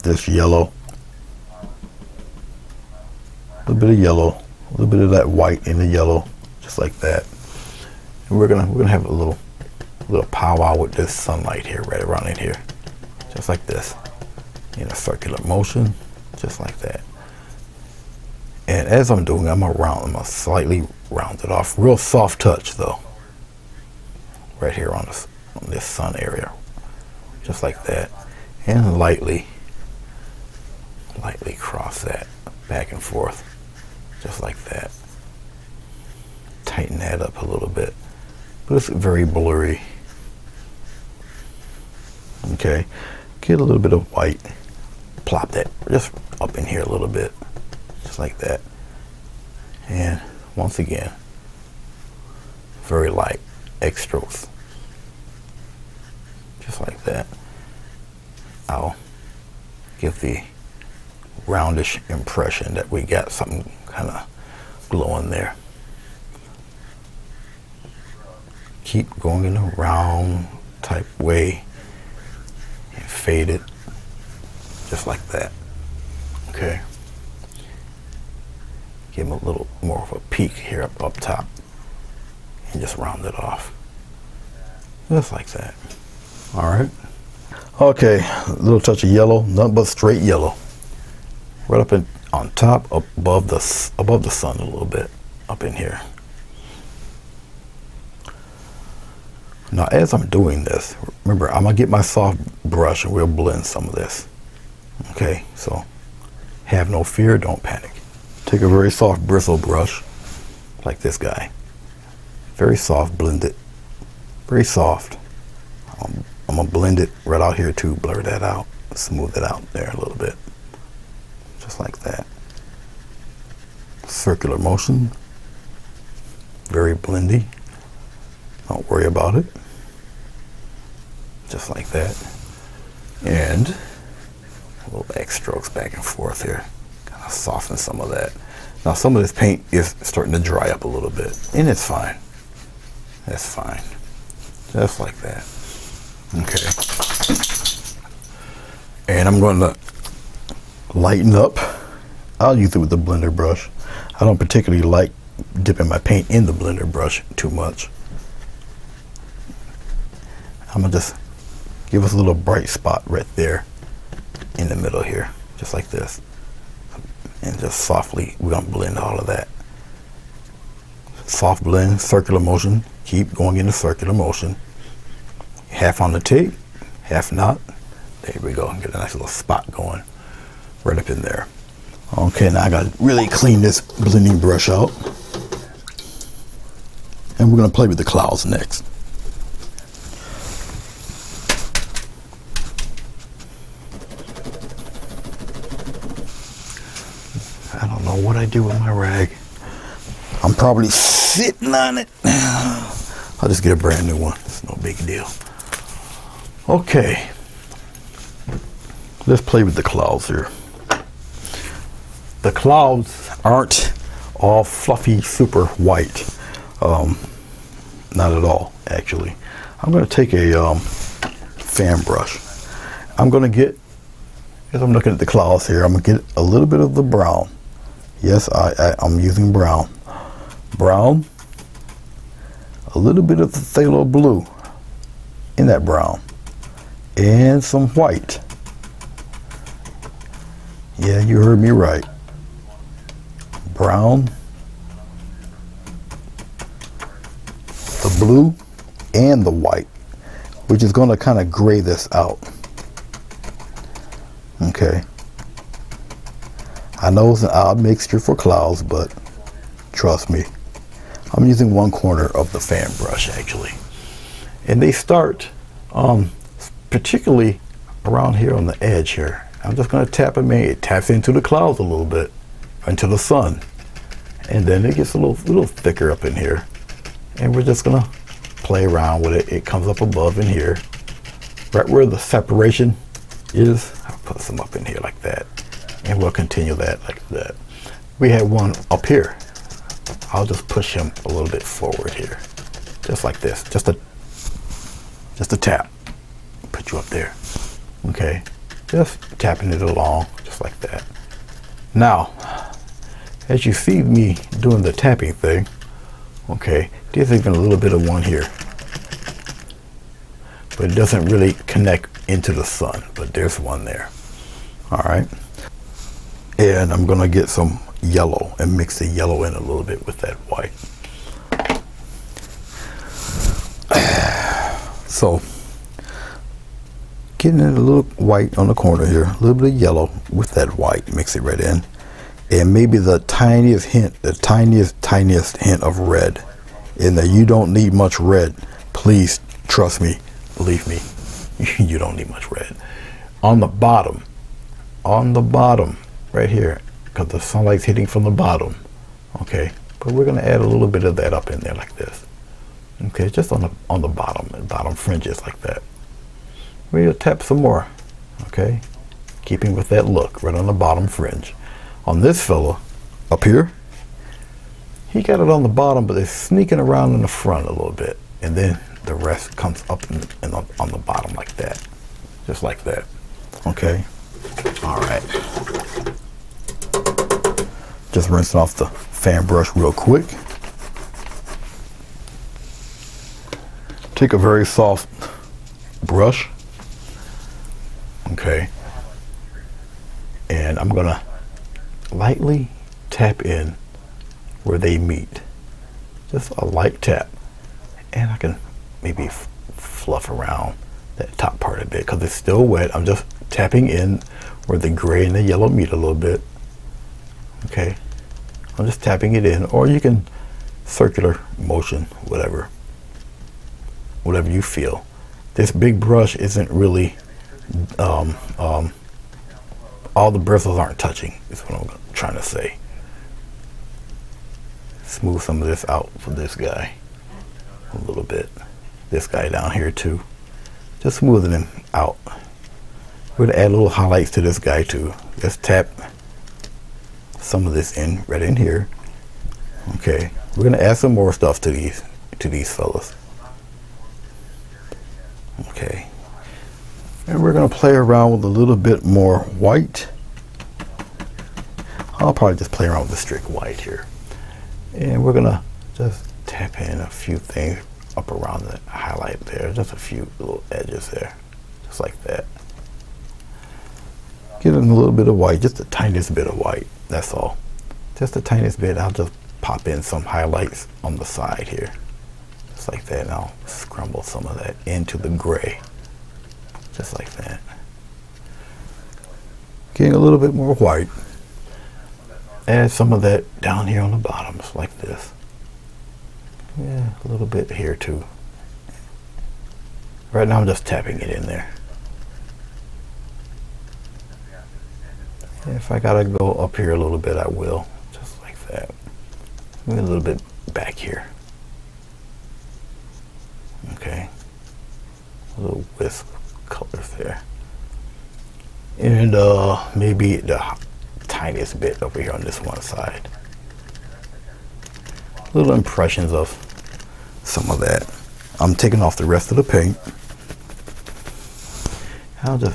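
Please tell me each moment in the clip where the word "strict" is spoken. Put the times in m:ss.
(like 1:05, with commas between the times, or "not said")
7:33.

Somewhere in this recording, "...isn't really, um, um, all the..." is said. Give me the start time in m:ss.
6:56.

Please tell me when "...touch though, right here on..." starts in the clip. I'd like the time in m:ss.
0:22.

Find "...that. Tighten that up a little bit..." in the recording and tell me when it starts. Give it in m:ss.
0:34.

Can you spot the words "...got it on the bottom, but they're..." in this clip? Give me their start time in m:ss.
6:05.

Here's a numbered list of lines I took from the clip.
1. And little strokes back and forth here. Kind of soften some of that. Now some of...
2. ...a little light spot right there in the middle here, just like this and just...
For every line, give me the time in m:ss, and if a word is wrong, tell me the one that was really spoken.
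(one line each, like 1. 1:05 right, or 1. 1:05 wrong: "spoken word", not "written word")
1. 2:13 right
2. 2:42 wrong: "bright", not "light".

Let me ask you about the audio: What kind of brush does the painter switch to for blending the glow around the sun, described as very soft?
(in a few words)
soft bristle brush.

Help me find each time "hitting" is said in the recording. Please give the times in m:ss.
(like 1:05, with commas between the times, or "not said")
5:47.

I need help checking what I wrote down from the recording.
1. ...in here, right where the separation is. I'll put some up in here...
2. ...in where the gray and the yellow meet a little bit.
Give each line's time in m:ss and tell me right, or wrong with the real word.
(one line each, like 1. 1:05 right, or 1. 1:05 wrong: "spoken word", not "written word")
1. 4:40 right
2. 6:43 right.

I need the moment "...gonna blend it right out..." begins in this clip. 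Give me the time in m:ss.
1:56.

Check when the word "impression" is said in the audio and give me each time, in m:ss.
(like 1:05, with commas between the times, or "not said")
1:02, 8:35.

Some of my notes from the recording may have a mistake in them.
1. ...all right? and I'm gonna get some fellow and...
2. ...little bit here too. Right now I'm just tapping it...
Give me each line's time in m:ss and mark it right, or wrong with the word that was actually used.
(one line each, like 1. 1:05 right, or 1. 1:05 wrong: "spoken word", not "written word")
1. 5:14 wrong: "yellow", not "fellow"
2. 8:07 right.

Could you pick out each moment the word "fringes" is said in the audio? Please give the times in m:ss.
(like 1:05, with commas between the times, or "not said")
5:54, 6:01.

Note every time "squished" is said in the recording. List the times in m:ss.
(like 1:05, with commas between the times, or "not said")
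not said.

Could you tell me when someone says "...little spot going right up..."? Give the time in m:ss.
2:59.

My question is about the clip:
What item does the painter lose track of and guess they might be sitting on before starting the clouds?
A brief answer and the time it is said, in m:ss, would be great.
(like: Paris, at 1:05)
rag, at 3:18.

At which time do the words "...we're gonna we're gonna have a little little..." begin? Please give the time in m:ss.
0:08.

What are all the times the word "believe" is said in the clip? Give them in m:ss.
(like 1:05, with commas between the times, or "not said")
5:40.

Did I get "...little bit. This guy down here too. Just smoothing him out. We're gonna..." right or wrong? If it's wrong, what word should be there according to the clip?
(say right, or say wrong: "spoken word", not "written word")
right.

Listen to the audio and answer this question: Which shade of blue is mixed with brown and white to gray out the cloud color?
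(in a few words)
phthalo blue.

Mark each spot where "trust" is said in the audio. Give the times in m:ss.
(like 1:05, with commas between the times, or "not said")
4:19, 5:39.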